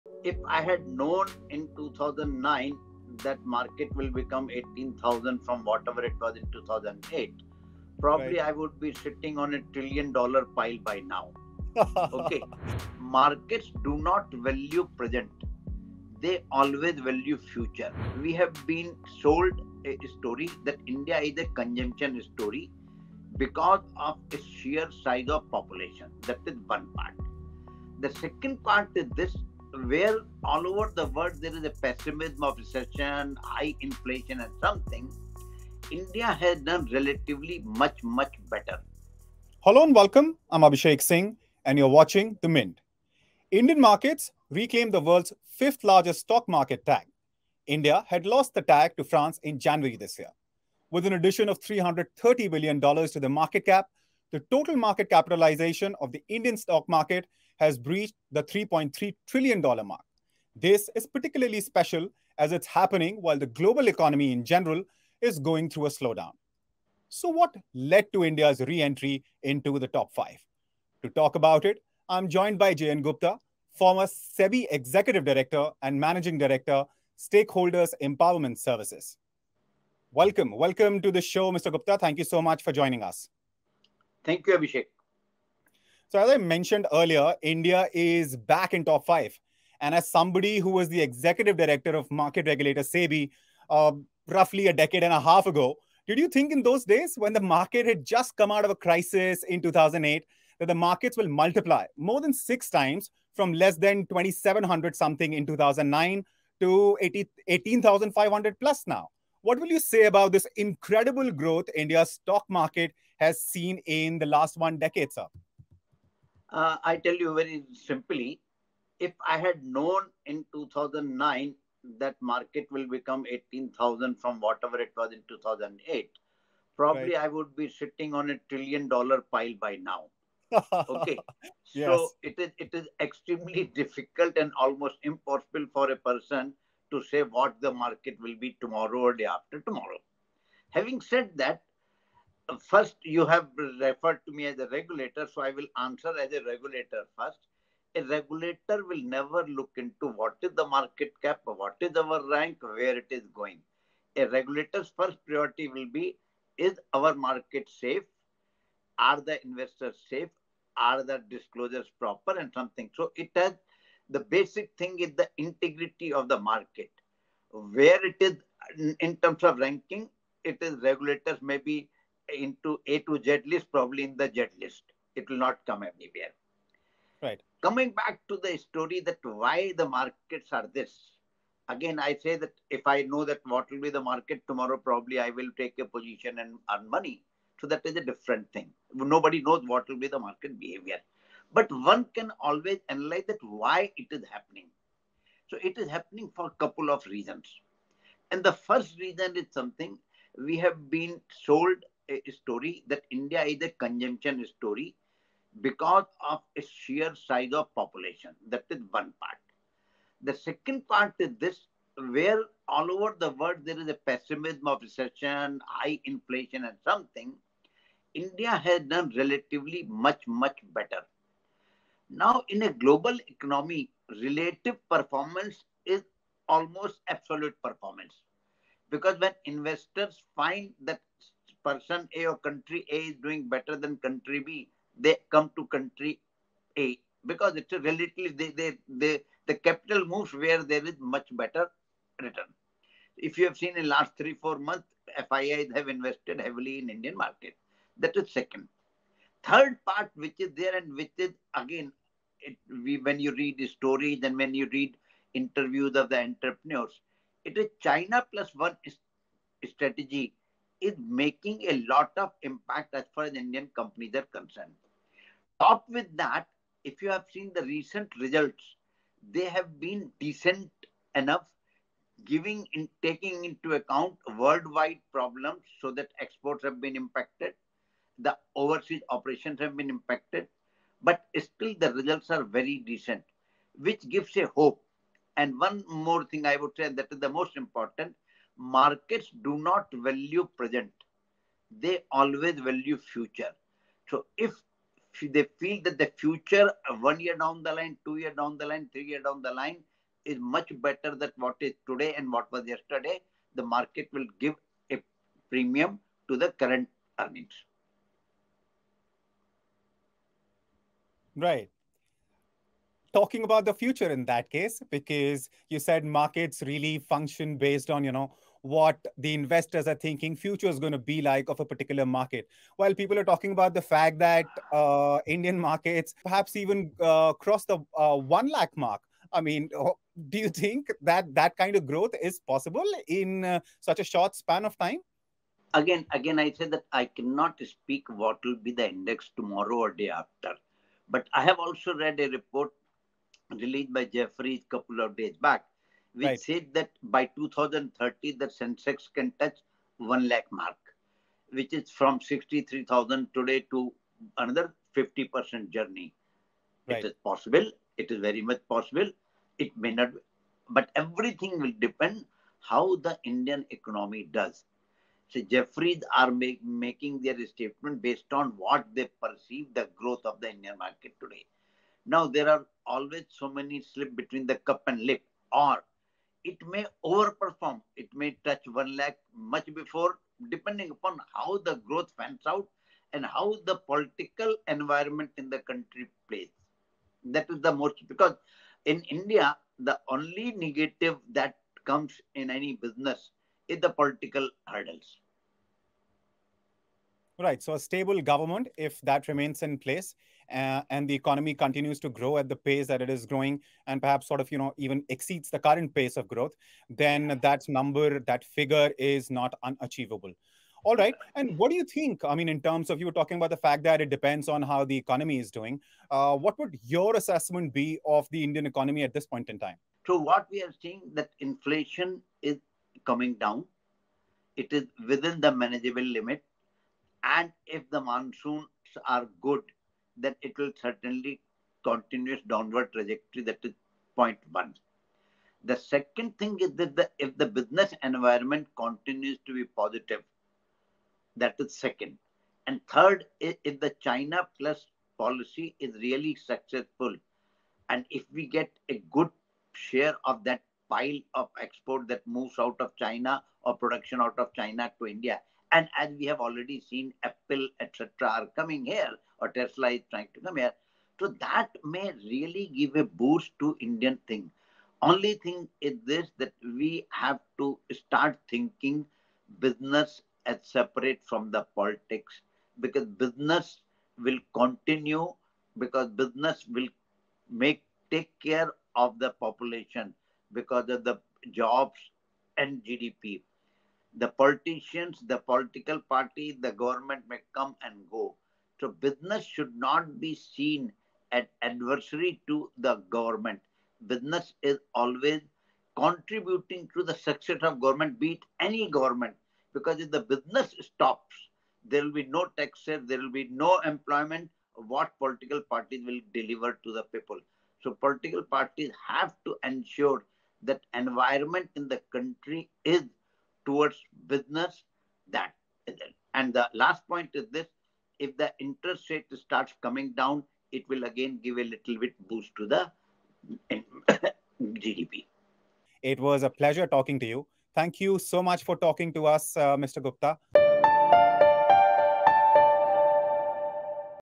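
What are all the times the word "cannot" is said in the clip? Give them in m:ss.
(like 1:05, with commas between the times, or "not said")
5:37.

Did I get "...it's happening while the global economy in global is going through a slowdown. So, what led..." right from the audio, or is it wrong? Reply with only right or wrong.
wrong.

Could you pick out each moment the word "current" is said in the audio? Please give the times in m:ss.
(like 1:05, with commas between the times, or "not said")
5:06, 6:45.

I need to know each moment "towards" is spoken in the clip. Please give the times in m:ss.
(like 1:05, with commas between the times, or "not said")
8:33.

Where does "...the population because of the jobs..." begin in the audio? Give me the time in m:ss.
7:59.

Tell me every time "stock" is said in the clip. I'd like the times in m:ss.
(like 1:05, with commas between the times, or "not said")
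0:46, 0:56, 1:52.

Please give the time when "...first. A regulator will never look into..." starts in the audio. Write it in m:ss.
2:27.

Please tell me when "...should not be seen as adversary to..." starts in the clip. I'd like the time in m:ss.
8:09.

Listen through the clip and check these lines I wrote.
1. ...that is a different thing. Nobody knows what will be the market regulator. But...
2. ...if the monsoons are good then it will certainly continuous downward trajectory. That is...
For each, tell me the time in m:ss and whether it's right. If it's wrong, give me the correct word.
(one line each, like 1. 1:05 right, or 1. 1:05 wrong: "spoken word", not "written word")
1. 3:07 wrong: "behavior", not "regulator"
2. 7:07 right.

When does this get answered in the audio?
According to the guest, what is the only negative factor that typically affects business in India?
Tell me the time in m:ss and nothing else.
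6:33.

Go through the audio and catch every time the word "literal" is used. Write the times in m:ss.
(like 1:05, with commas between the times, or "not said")
not said.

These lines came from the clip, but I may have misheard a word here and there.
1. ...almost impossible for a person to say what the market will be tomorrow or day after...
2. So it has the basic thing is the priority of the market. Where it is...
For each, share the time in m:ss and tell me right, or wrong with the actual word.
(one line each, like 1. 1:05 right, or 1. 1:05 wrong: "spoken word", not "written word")
1. 2:14 right
2. 2:42 wrong: "integrity", not "priority".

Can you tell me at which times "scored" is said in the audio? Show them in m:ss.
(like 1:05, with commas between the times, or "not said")
not said.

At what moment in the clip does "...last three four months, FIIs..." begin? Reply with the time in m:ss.
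4:03.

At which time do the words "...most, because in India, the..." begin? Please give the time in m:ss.
6:27.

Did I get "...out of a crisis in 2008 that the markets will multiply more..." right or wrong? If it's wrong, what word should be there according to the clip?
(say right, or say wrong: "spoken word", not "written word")
right.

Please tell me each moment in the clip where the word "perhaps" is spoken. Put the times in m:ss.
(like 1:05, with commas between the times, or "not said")
5:26, 6:44.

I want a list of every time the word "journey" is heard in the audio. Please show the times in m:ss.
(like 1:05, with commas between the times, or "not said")
5:55.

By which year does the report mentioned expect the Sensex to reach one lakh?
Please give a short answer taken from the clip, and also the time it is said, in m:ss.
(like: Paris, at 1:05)
2030, at 5:47.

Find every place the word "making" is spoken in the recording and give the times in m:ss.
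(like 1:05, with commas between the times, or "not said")
4:21, 6:06.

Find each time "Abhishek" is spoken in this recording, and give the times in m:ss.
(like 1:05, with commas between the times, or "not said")
0:40, 1:24.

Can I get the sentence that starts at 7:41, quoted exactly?
So that may really give a boost to Indian thing.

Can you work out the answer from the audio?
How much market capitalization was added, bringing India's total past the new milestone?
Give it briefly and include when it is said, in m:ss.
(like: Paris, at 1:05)
$330 billion, at 0:51.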